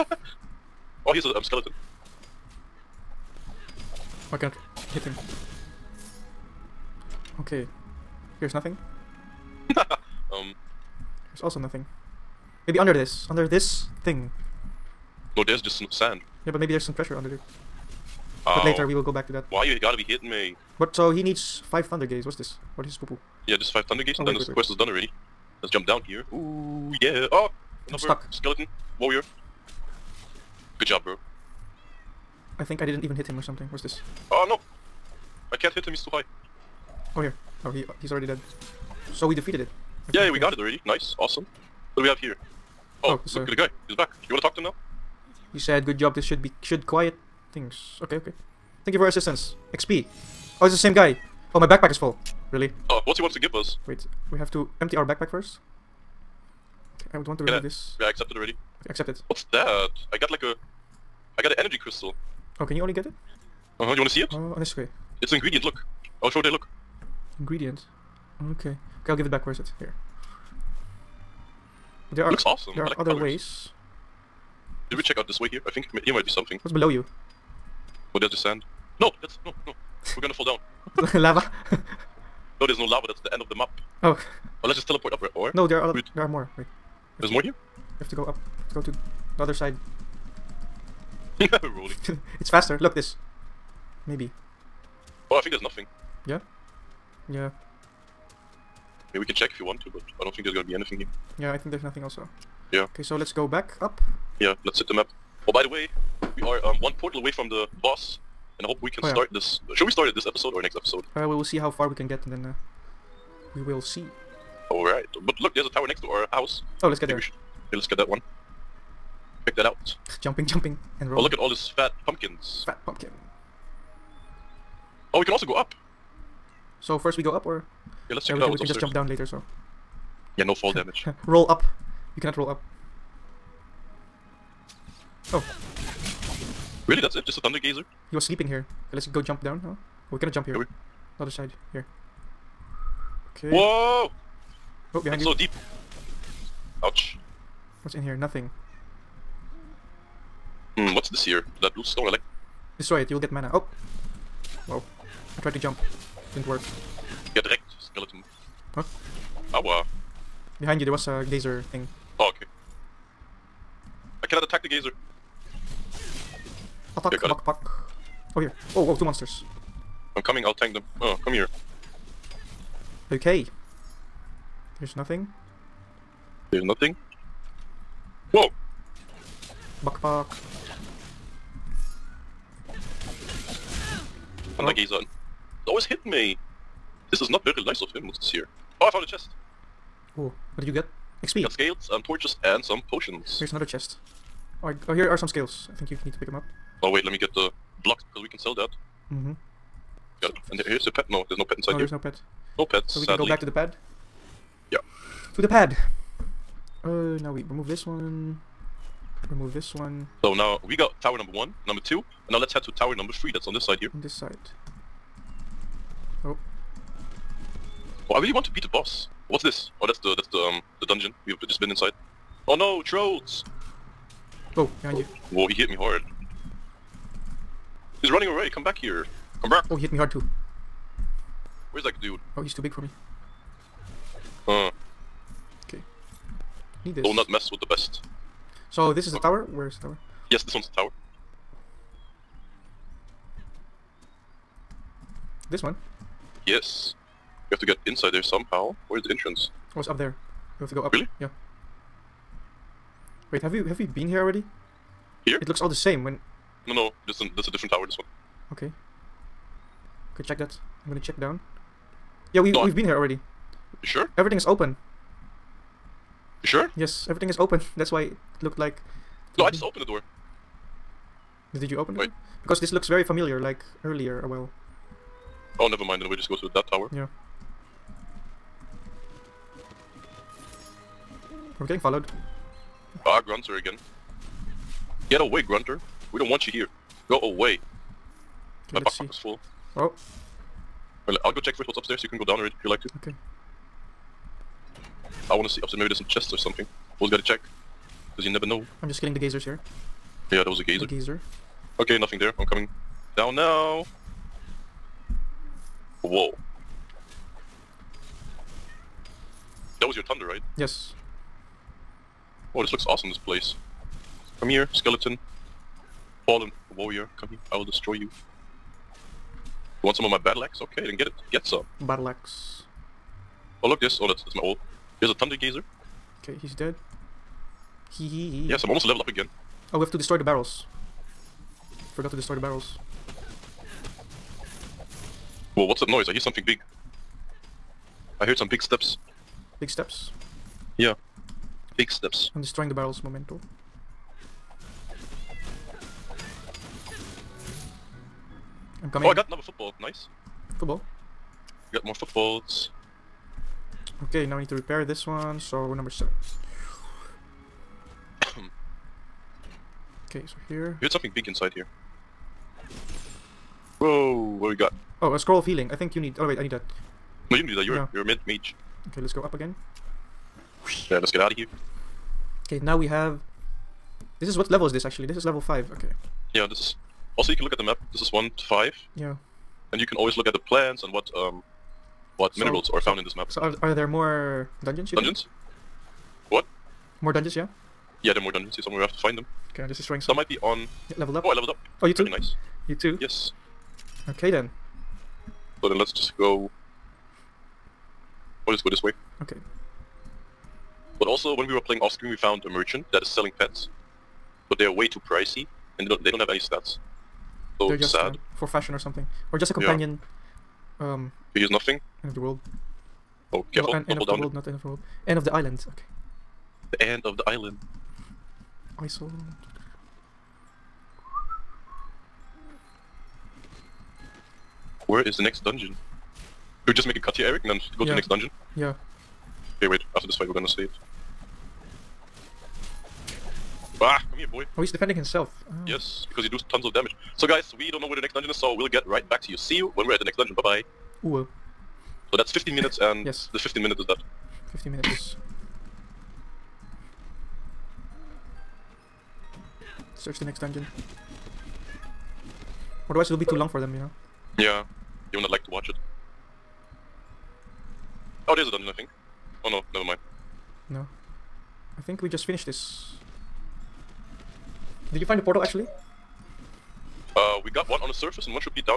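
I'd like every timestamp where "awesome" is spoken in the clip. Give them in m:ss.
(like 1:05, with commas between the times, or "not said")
0:41, 1:12, 5:12.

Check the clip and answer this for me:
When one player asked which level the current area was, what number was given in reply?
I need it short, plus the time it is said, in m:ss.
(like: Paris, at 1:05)
5, at 6:15.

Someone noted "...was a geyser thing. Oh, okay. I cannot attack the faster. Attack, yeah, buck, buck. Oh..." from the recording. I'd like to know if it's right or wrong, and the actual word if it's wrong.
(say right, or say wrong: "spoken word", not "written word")
wrong: "geyser", not "faster".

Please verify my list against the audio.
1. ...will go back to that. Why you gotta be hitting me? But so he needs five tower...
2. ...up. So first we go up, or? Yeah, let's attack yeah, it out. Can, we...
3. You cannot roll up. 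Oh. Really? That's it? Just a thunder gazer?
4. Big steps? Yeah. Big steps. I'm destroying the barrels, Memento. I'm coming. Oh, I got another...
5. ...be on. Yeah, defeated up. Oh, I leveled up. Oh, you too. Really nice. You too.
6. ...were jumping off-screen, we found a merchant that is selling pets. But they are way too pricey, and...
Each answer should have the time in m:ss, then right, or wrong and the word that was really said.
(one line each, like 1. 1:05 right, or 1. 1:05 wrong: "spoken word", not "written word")
1. 0:18 wrong: "thunder", not "tower"
2. 2:05 wrong: "check", not "attack"
3. 2:12 right
4. 5:39 right
5. 6:30 wrong: "leveled", not "defeated"
6. 6:41 wrong: "playing", not "jumping".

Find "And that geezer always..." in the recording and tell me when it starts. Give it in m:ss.
3:04.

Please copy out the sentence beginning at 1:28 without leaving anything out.
To go to the other side.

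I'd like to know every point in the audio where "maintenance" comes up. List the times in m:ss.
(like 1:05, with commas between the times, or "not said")
not said.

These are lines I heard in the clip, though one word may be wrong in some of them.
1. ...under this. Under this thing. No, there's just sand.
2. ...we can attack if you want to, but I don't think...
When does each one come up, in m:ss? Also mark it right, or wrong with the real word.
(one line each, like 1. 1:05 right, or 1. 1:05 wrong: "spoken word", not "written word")
1. 0:12 right
2. 1:39 wrong: "check", not "attack".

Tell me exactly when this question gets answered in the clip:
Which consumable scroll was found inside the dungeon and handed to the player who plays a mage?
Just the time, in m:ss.
6:05.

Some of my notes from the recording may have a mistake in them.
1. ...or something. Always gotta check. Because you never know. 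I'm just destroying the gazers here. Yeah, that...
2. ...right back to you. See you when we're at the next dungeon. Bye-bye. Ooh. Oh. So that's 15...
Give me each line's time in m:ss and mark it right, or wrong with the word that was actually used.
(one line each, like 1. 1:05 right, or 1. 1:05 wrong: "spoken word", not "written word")
1. 4:56 wrong: "kidding", not "destroying"
2. 7:18 right.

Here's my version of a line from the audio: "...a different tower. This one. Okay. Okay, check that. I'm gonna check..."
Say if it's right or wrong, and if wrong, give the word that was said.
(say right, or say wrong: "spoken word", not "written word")
right.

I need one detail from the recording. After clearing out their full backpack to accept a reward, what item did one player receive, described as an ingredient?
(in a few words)
Energy crystal.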